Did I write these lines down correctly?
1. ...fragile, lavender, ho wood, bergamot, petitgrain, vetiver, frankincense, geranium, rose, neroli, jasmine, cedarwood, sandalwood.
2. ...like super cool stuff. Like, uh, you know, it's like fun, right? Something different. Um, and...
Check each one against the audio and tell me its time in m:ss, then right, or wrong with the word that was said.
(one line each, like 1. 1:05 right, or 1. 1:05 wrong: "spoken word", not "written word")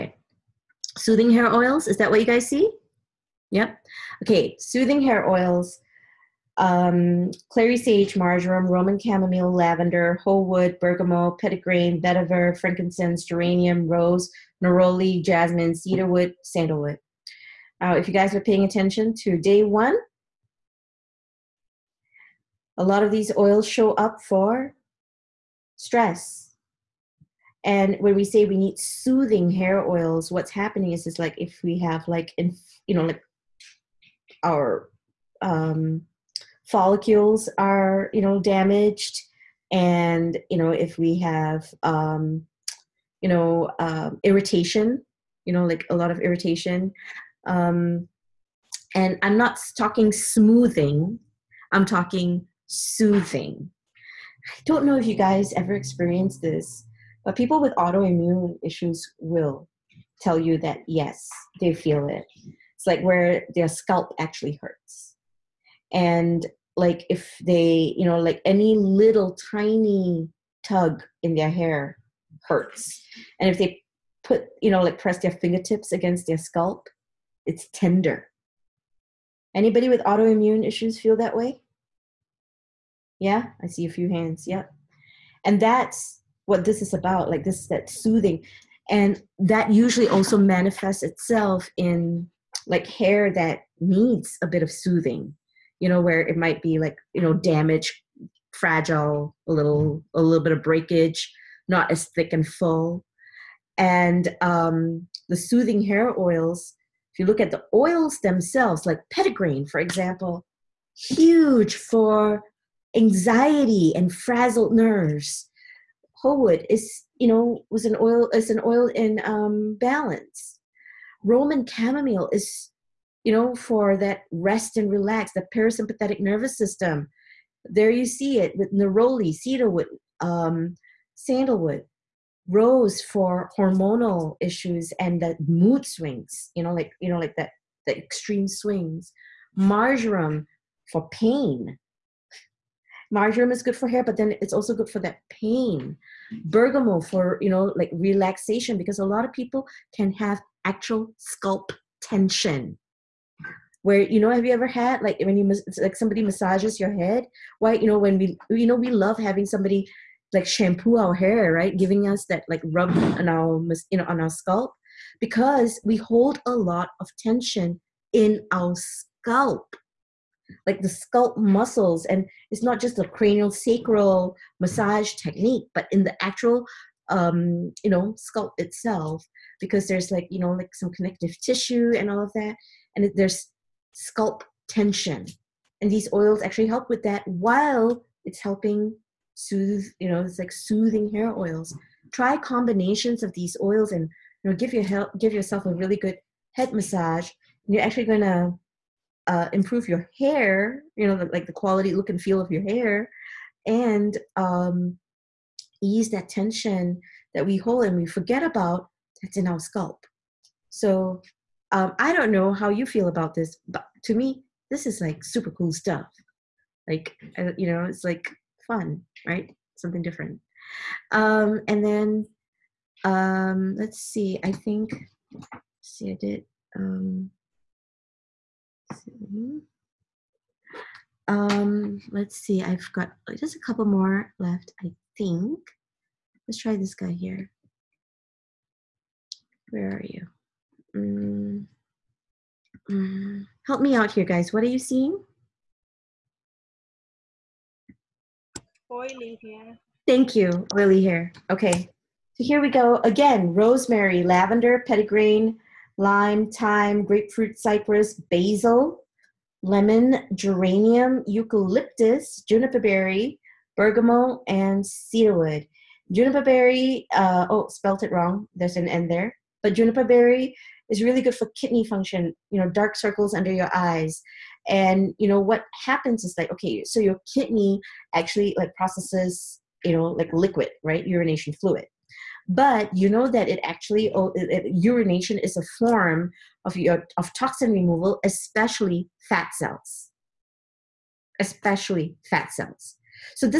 1. 0:08 wrong: "chamomile", not "fragile"
2. 3:34 right.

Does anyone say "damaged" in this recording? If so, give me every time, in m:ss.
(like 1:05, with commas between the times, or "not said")
0:38, 1:37.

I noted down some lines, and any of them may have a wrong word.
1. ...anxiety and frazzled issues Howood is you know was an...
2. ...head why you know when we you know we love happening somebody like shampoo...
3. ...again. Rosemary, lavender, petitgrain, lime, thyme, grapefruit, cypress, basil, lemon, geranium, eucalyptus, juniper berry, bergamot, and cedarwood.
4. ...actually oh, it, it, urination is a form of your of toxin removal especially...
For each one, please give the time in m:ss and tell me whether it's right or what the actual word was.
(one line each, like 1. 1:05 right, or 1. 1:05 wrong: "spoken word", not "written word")
1. 1:52 wrong: "nerves", not "issues"
2. 2:36 wrong: "having", not "happening"
3. 4:13 right
4. 4:43 right.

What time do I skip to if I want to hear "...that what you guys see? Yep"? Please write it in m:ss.
0:01.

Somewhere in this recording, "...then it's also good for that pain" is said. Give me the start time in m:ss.
2:24.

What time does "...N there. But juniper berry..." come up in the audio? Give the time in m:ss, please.
4:28.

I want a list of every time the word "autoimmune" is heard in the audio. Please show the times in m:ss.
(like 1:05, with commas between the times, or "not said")
0:57, 1:20.